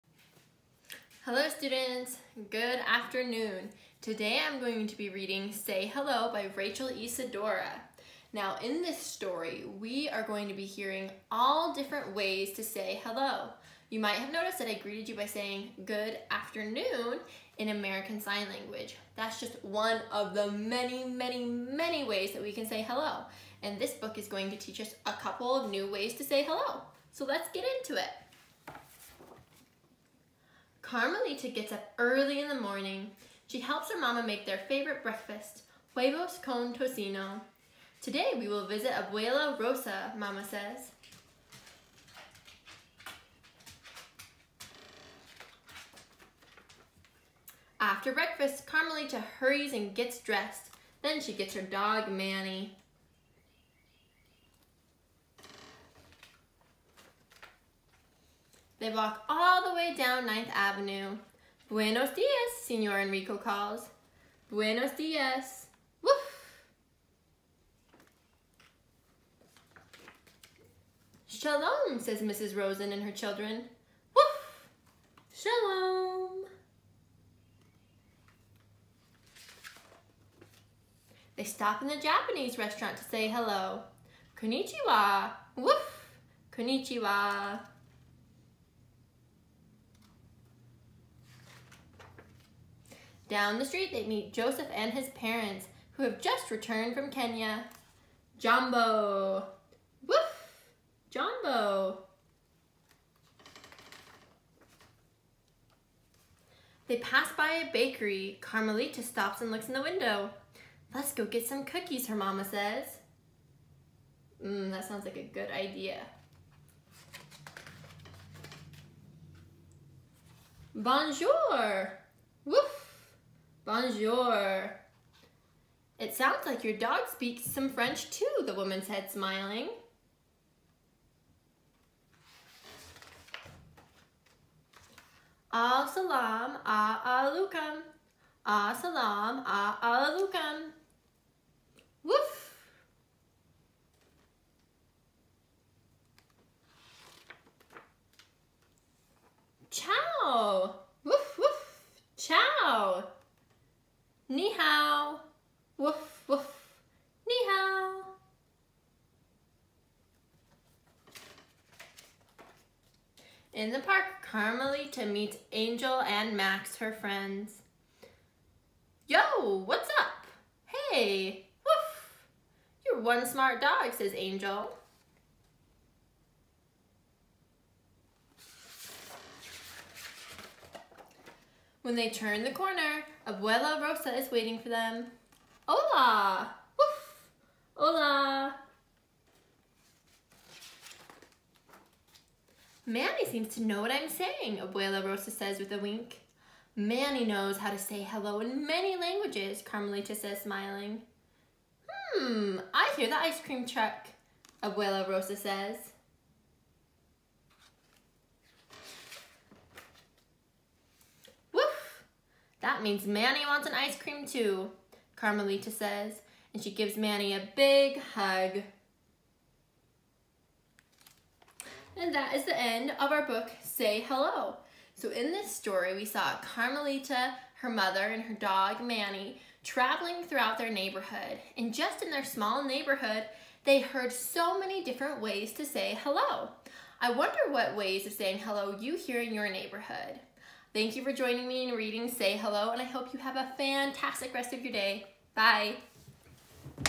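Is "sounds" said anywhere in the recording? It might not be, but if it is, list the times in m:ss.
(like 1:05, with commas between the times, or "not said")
1:54, 2:06.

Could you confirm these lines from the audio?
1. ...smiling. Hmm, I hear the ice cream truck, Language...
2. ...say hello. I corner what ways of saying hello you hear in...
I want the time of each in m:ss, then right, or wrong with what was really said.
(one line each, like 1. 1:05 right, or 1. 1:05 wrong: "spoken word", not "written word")
1. 3:20 wrong: "Abuela", not "Language"
2. 3:55 wrong: "wonder", not "corner".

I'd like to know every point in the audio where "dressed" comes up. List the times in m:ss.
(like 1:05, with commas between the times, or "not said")
0:50.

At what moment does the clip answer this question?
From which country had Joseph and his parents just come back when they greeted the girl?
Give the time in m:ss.
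1:37.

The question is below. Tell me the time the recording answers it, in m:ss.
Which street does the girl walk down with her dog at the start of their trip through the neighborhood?
1:00.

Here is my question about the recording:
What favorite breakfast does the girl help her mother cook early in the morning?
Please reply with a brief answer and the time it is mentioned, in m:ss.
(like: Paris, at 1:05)
huevos con tocino, at 0:35.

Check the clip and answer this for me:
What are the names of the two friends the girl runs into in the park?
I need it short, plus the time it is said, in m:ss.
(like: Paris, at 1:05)
Angel and Max, at 2:45.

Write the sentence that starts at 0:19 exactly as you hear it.
That's just one of the many, many, many ways that we can say hello.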